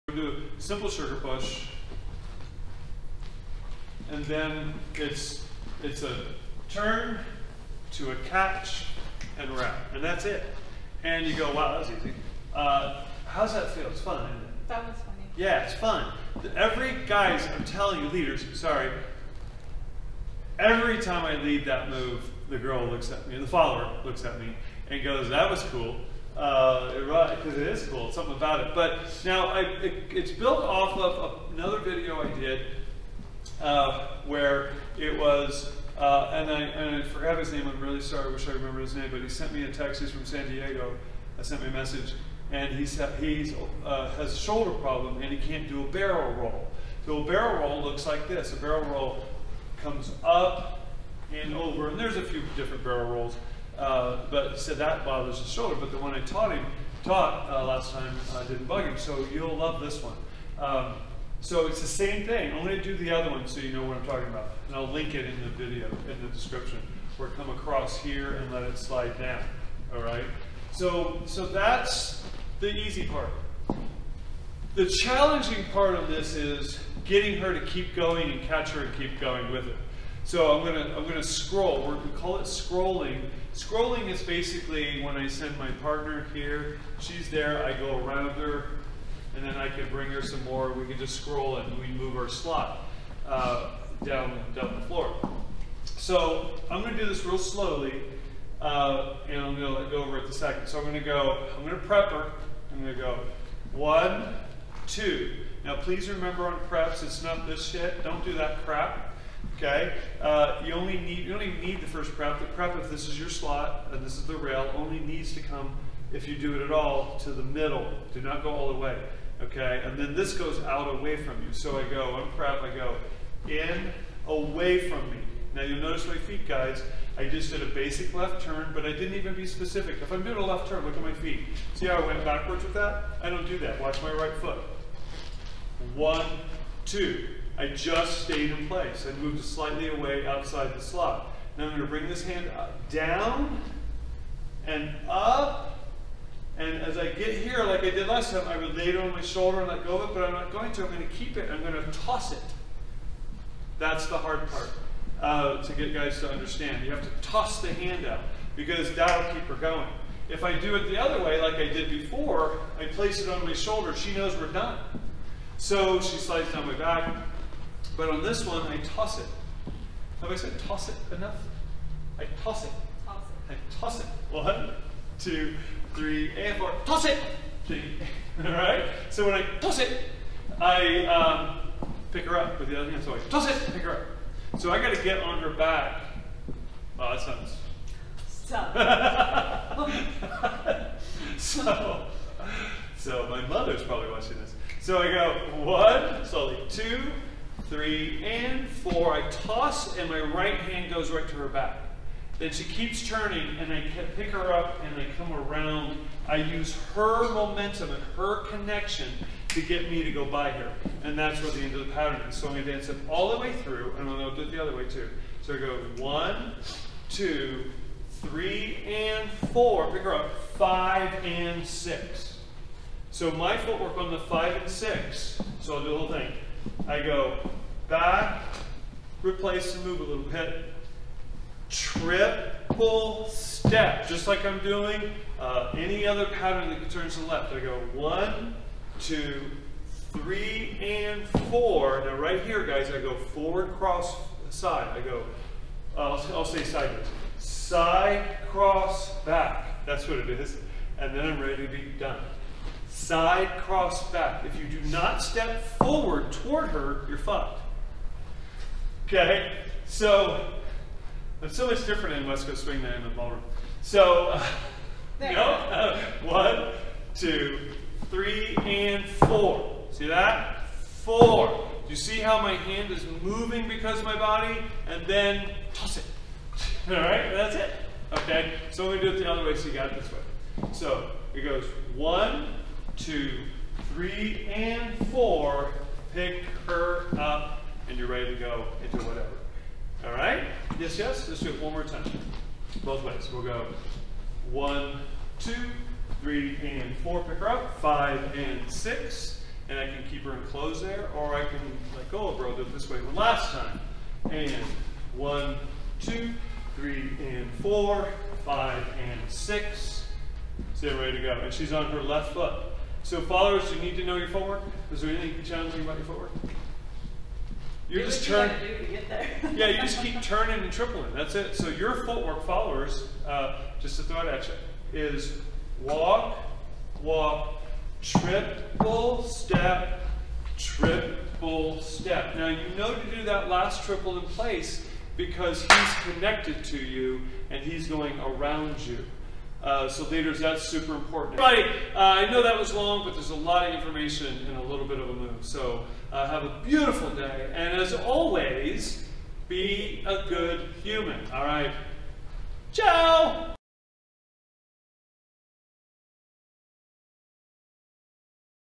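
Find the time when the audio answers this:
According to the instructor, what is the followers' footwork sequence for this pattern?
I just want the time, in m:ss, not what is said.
5:25.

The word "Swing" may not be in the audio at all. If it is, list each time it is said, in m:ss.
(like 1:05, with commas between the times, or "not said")
4:22.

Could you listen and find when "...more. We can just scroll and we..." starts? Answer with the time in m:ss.
1:30.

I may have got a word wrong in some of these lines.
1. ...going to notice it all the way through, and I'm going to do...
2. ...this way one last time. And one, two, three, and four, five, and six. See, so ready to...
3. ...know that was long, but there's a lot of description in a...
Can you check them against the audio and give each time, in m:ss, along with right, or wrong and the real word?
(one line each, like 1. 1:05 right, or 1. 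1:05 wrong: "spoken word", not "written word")
1. 3:32 wrong: "dance", not "notice"
2. 5:02 right
3. 5:42 wrong: "information", not "description".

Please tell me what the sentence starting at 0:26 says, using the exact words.
Uh, right, because it is cool, something about it.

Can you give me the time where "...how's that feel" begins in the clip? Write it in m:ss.
0:13.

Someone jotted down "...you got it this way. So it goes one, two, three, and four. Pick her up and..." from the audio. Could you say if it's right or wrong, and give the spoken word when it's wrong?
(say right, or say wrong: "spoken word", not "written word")
right.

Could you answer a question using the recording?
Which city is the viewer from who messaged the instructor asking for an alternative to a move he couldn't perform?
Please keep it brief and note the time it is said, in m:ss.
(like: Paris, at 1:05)
San Diego, at 0:40.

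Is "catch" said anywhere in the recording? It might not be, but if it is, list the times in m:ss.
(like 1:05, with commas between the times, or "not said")
0:08, 1:18.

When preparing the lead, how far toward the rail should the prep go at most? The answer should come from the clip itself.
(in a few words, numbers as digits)
to the middle.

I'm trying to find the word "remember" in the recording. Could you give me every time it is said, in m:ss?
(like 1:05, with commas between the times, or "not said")
0:38, 1:46.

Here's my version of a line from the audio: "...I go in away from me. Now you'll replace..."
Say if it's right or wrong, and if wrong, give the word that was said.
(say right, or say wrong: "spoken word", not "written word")
wrong: "notice", not "replace".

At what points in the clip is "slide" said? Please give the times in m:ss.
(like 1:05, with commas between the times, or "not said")
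1:08, 2:46.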